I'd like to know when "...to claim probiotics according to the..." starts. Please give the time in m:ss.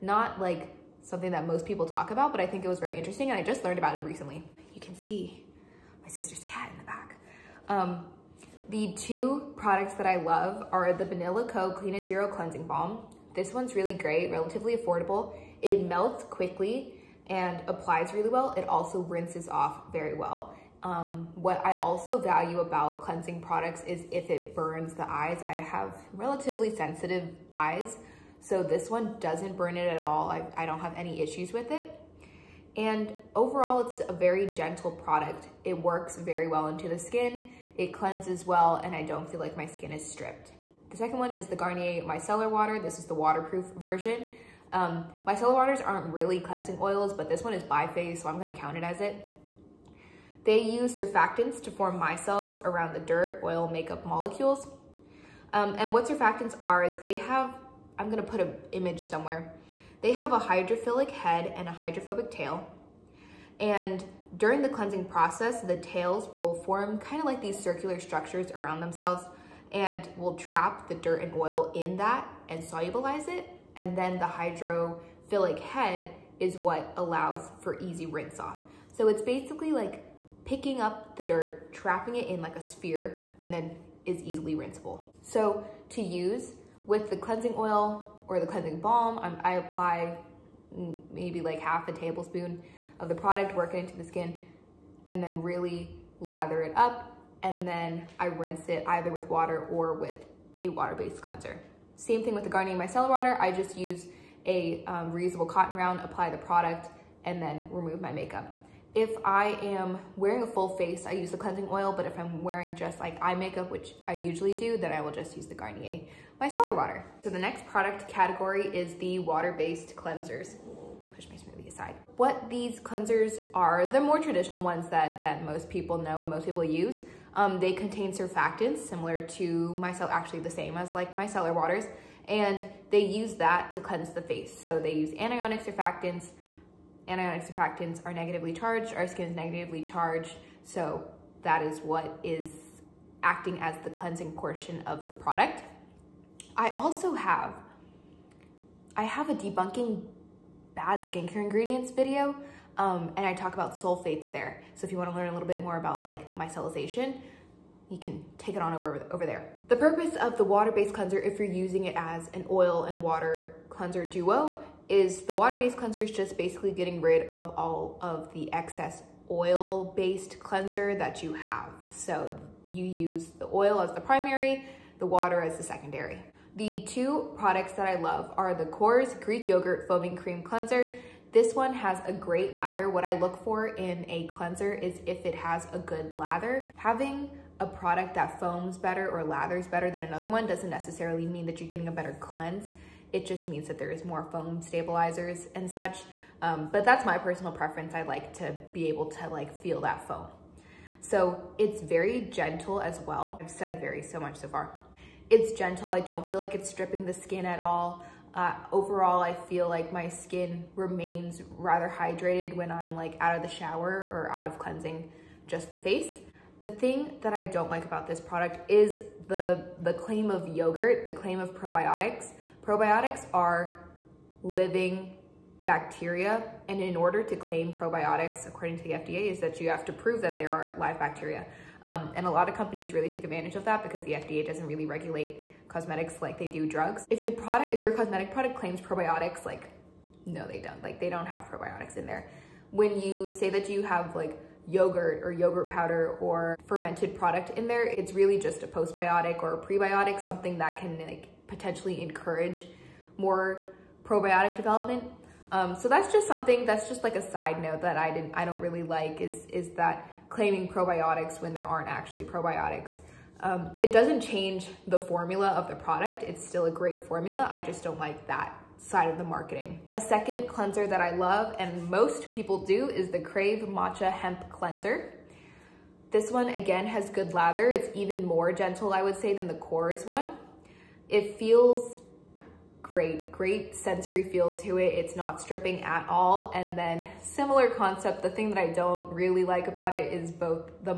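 3:47.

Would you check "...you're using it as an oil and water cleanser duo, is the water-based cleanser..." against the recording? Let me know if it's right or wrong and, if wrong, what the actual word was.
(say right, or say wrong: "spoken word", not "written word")
right.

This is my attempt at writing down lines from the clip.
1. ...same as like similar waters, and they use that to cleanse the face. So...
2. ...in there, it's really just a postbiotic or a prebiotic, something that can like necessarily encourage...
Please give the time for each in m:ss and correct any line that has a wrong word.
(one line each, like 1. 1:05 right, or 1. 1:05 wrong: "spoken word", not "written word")
1. 2:10 wrong: "micellar", not "similar"
2. 4:07 wrong: "potentially", not "necessarily".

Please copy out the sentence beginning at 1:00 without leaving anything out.
They have a hydrophilic head and a hydrophobic tail.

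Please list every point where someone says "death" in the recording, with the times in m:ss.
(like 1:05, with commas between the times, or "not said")
not said.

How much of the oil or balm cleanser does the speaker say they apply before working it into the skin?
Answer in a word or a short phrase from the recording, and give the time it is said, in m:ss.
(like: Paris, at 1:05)
half a tablespoon, at 1:31.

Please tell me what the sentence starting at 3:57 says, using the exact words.
If your product, if your cosmetic product claims probiotics, like no, they don't.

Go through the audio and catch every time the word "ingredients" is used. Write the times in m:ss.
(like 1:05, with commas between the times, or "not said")
2:31.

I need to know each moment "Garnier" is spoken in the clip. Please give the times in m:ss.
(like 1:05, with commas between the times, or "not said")
0:41, 1:42, 1:55.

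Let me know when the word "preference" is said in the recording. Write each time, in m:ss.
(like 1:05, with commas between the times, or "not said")
3:17.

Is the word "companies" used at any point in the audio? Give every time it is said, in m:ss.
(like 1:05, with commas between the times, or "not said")
3:52.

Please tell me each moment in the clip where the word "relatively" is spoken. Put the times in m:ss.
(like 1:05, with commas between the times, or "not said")
0:14, 0:26.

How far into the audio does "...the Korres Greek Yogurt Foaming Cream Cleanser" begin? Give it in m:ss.
2:58.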